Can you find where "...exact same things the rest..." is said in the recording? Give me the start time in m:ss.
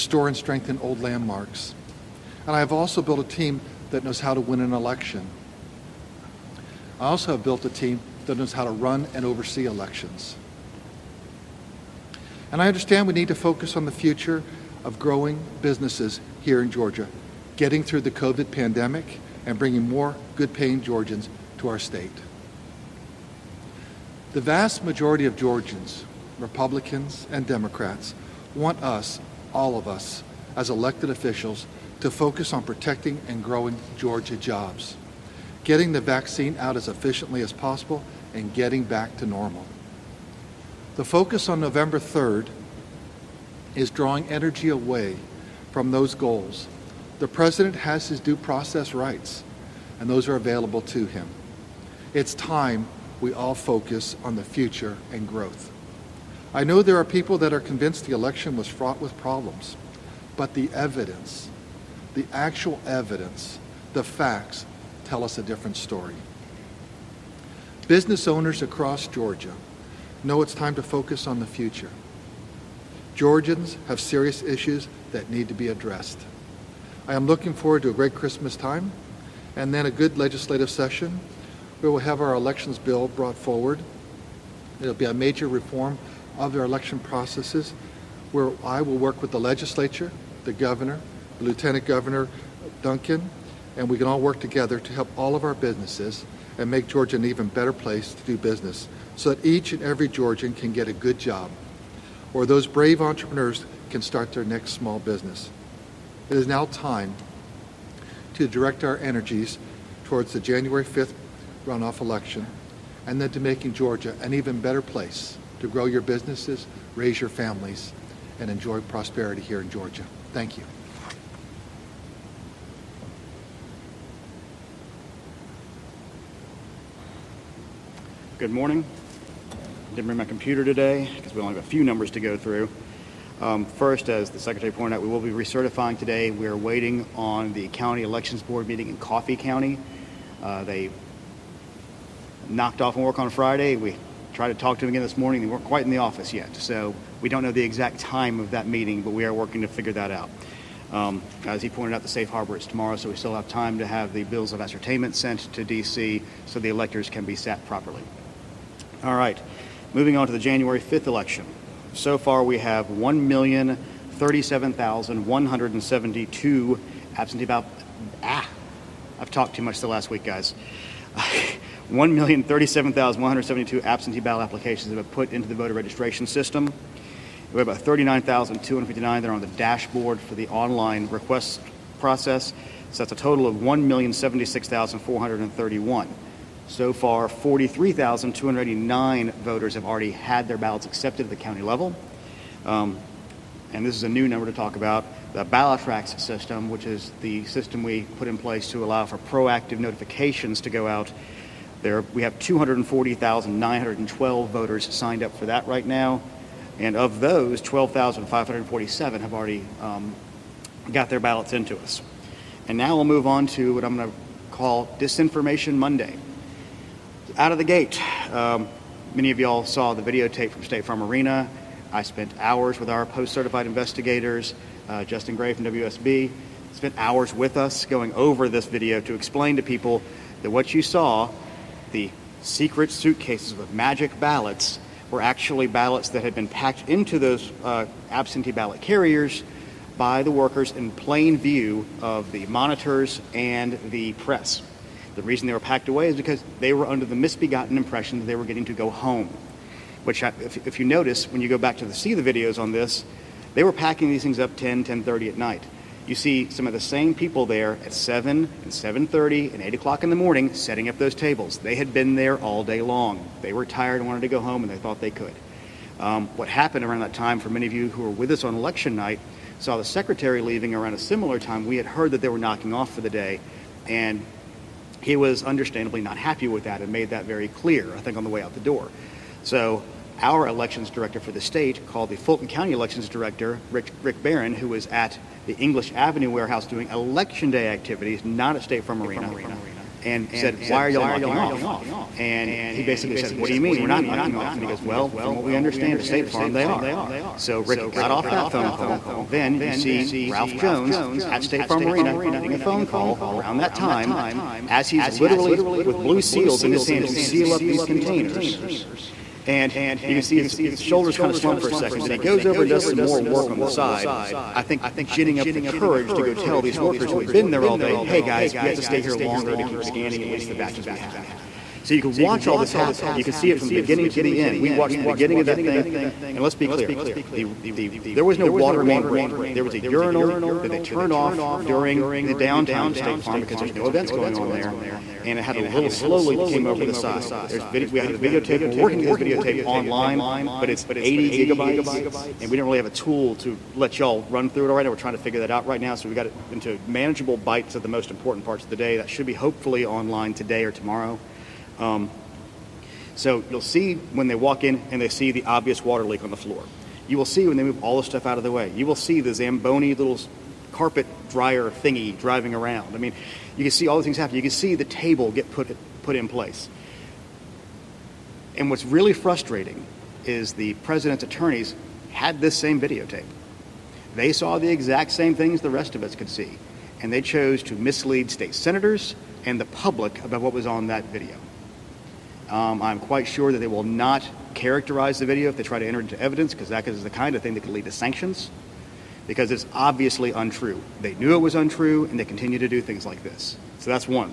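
6:14.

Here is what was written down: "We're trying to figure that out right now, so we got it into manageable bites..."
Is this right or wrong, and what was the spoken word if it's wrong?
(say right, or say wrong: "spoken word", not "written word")
right.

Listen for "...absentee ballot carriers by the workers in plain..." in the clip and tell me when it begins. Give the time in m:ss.
3:58.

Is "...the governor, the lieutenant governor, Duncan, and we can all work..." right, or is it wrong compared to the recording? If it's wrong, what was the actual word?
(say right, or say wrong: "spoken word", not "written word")
right.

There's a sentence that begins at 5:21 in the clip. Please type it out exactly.
So you can watch all this happen.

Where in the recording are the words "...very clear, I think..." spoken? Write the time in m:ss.
4:37.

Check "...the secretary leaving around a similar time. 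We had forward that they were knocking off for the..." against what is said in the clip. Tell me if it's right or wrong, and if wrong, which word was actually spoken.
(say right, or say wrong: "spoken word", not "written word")
wrong: "heard", not "forward".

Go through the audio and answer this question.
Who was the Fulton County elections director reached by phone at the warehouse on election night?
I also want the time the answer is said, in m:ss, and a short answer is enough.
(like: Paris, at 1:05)
Rick Barron, at 4:44.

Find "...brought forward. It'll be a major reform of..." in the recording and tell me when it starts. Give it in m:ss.
1:23.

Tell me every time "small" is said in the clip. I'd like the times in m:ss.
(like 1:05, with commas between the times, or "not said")
1:44.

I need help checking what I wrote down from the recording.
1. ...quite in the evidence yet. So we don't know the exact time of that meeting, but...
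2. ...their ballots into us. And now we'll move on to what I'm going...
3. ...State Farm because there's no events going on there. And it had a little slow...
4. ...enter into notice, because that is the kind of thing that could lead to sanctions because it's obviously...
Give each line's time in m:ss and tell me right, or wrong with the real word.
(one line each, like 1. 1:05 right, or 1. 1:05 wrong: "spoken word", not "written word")
1. 2:25 wrong: "office", not "evidence"
2. 3:31 right
3. 5:32 right
4. 6:25 wrong: "evidence", not "notice".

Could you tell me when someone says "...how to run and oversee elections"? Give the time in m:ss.
0:08.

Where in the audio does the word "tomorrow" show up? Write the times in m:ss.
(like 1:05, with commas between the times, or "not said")
2:32, 5:50.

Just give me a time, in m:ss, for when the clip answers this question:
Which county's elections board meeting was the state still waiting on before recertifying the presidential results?
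2:18.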